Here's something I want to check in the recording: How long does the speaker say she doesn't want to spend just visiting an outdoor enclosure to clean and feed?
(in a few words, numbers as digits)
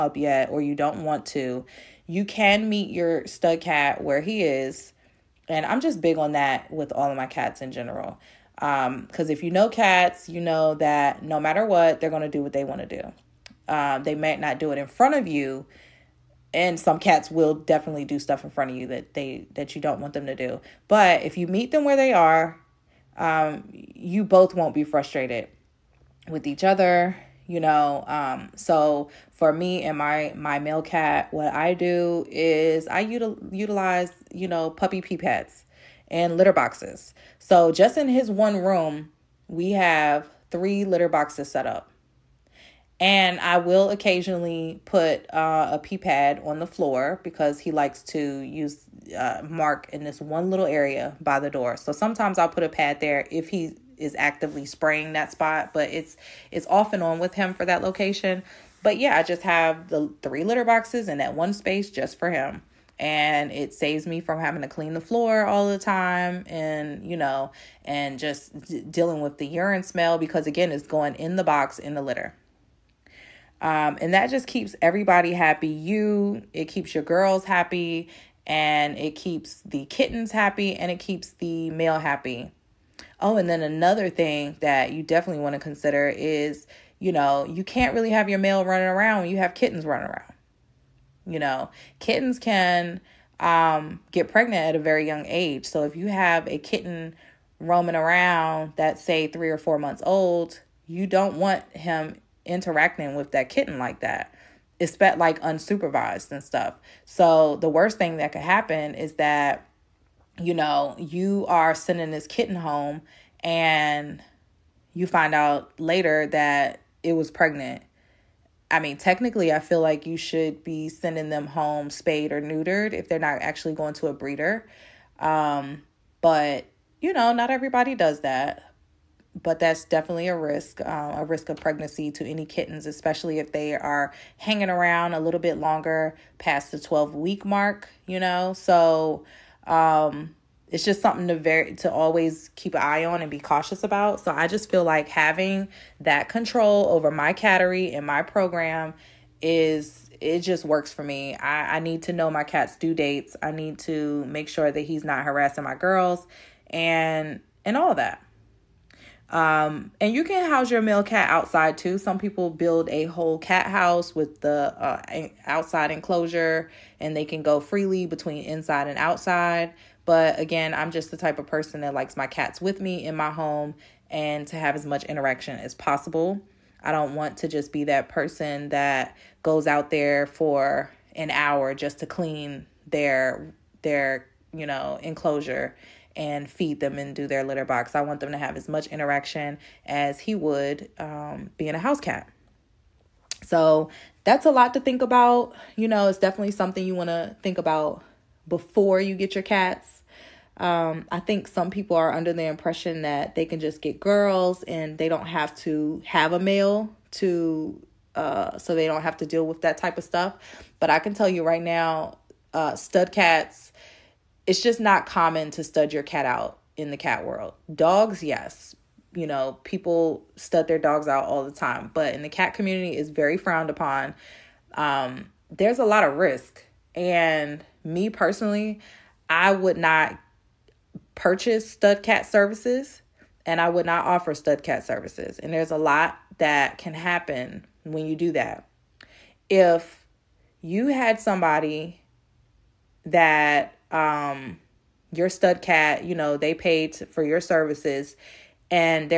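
An hour.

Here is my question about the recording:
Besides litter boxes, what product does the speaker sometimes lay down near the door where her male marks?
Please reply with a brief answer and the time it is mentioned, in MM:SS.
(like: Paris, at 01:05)
Puppy pee pads, at 00:34.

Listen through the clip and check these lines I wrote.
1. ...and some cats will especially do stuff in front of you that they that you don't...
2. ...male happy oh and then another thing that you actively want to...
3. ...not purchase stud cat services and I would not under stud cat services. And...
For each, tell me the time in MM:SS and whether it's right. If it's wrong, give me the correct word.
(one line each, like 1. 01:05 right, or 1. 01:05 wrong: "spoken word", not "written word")
1. 00:16 wrong: "definitely", not "especially"
2. 01:21 wrong: "definitely", not "actively"
3. 03:49 wrong: "offer", not "under".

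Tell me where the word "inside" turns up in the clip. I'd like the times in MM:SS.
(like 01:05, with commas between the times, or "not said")
02:48.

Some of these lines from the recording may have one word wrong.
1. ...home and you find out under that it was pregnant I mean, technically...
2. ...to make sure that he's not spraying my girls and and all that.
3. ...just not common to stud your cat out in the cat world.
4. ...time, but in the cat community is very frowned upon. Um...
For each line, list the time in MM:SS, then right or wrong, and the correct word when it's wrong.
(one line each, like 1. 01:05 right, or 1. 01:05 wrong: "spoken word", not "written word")
1. 01:52 wrong: "later", not "under"
2. 02:33 wrong: "harassing", not "spraying"
3. 03:34 right
4. 03:41 right.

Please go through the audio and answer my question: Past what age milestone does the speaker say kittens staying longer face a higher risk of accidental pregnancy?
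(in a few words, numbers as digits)
12 weeks.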